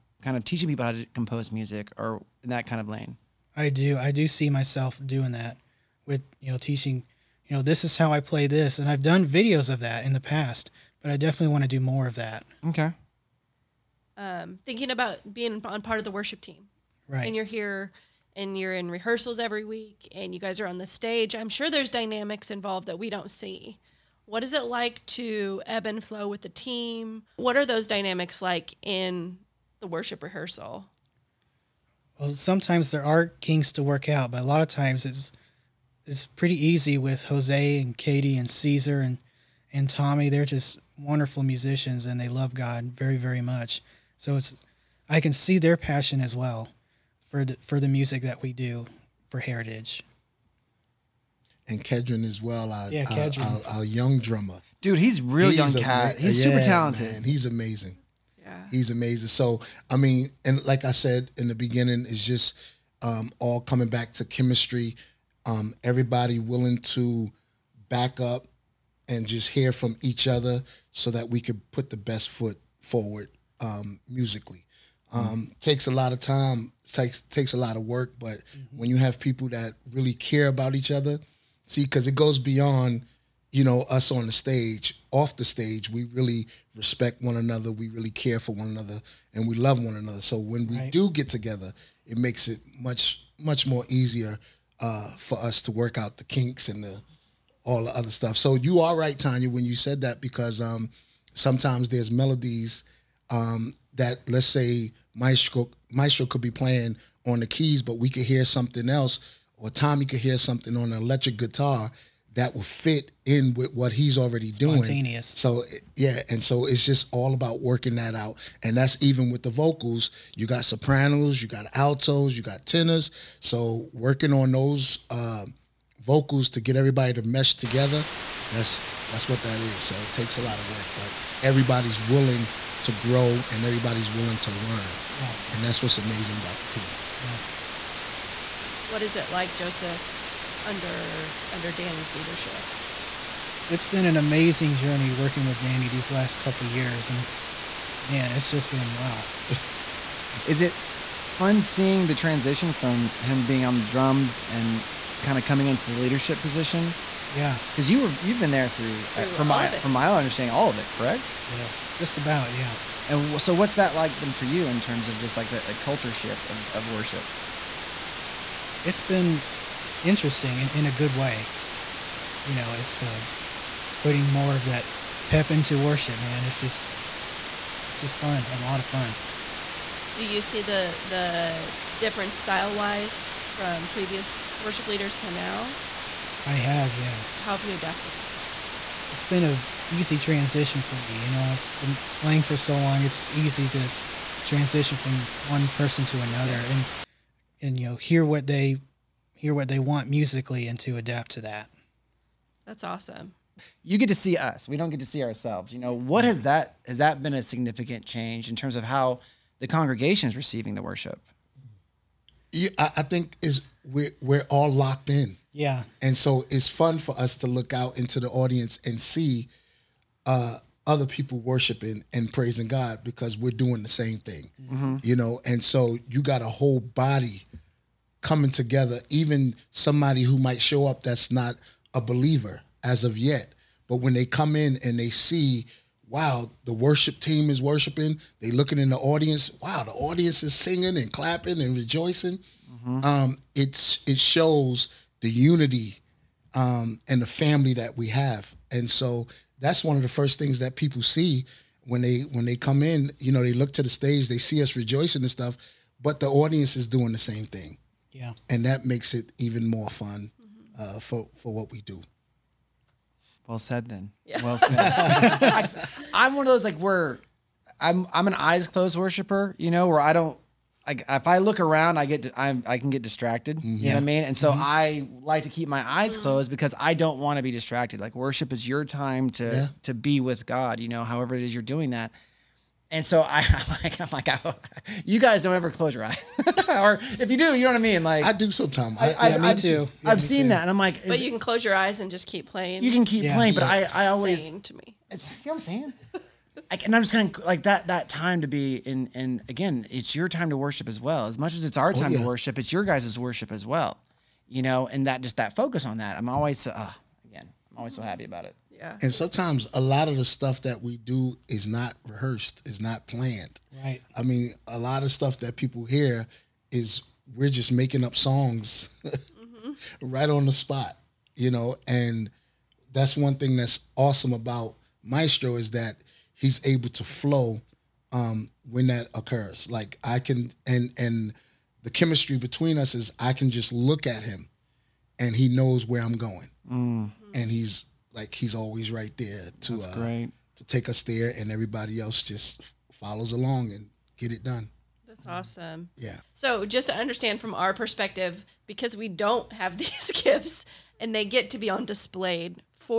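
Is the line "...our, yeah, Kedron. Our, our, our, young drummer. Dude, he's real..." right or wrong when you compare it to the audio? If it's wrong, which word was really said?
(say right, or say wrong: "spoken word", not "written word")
right.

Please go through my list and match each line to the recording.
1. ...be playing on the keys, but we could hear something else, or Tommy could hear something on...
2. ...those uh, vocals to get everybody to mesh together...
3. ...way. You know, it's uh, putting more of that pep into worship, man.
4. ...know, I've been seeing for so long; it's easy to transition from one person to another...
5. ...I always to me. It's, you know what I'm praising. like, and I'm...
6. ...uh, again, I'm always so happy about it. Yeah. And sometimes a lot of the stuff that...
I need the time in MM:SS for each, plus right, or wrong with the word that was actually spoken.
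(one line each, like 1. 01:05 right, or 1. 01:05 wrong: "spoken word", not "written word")
1. 01:46 right
2. 02:04 right
3. 02:51 right
4. 03:11 wrong: "playing", not "seeing"
5. 04:53 wrong: "saying", not "praising"
6. 05:06 right.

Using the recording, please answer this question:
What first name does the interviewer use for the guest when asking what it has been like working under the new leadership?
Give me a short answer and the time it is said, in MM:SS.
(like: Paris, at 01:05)
Joseph, at 02:19.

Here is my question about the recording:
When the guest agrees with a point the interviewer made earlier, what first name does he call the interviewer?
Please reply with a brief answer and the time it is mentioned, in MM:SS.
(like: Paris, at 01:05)
Tonya, at 01:39.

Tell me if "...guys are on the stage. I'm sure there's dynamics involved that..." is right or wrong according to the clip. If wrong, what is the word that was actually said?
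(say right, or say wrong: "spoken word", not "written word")
right.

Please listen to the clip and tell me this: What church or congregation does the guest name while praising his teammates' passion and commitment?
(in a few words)
Heritage.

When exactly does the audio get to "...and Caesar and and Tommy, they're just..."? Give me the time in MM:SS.
00:38.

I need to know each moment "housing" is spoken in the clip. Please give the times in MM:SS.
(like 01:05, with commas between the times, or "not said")
not said.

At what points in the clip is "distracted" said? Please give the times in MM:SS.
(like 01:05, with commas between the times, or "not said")
04:33, 04:37.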